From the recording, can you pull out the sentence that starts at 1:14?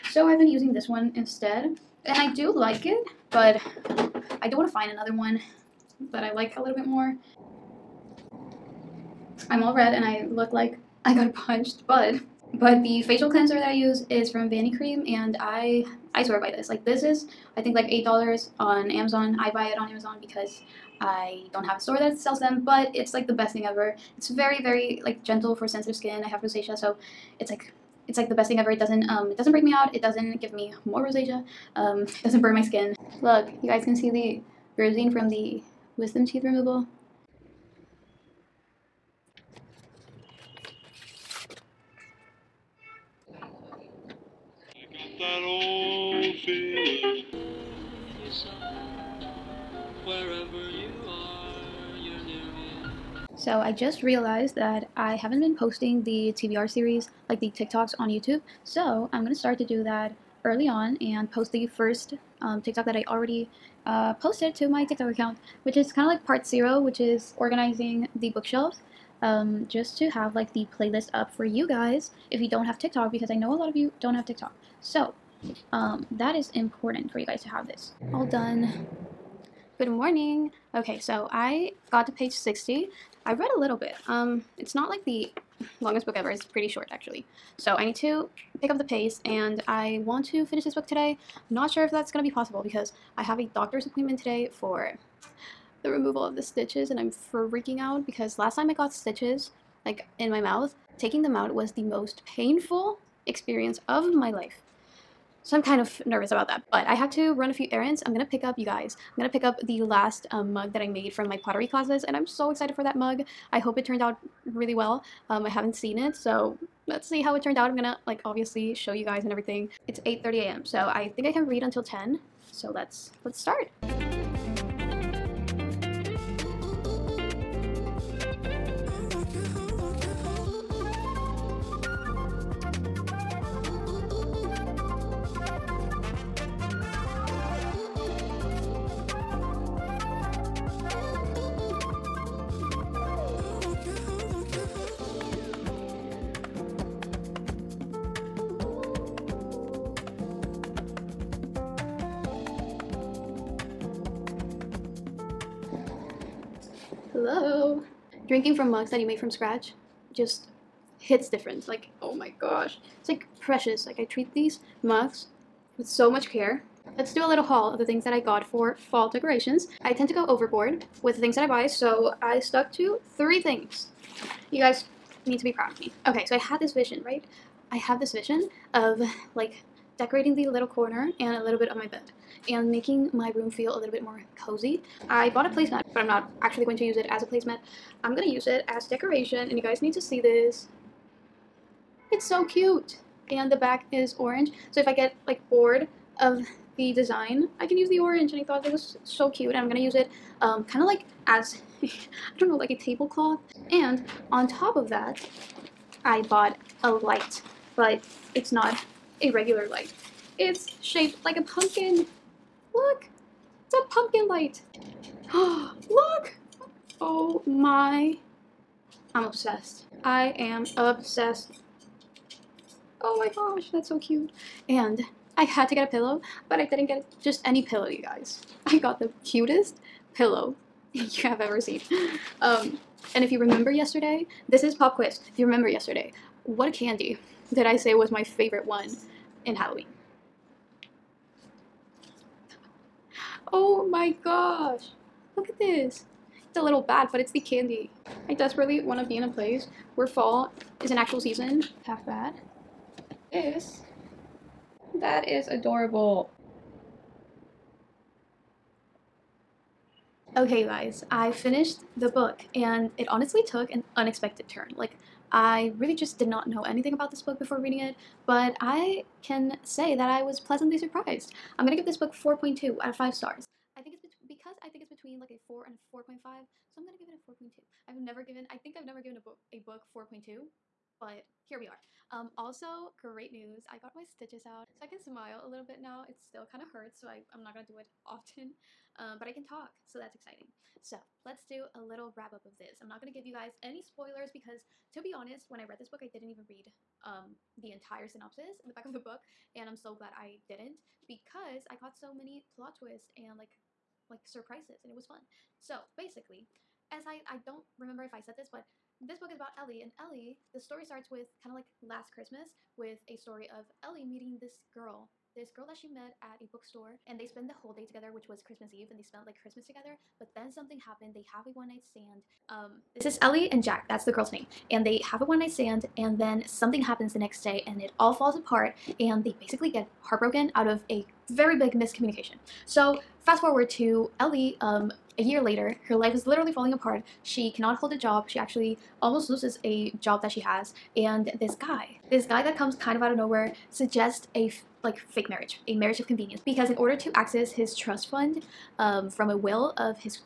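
So um, that is important for you guys to have this.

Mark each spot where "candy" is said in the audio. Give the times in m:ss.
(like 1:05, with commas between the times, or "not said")
3:56, 4:07.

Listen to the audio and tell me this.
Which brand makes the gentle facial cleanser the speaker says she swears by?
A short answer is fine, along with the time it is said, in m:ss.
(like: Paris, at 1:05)
Vanicream, at 0:14.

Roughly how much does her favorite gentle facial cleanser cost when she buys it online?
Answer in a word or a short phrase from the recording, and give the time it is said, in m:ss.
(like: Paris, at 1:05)
$8, at 0:17.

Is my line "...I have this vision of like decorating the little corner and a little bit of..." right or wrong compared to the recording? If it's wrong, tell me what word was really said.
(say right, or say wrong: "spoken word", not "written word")
right.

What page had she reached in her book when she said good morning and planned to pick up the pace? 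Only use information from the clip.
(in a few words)
60.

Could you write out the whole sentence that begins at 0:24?
It's very, very like gentle for sensitive skin.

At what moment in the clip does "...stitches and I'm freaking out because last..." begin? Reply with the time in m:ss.
1:36.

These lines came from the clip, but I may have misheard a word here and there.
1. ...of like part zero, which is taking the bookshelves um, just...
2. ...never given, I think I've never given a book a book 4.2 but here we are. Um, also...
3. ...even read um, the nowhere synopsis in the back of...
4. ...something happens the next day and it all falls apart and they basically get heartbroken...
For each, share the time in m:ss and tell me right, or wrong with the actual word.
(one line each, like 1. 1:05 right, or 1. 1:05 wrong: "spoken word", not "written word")
1. 1:06 wrong: "organizing", not "taking"
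2. 4:37 right
3. 4:56 wrong: "entire", not "nowhere"
4. 5:26 right.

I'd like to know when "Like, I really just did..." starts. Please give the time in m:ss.
4:24.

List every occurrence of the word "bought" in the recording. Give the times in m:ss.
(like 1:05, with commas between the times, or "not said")
3:05, 3:26.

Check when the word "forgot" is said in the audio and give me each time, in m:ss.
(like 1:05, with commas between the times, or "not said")
not said.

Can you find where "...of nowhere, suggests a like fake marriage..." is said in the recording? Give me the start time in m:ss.
5:43.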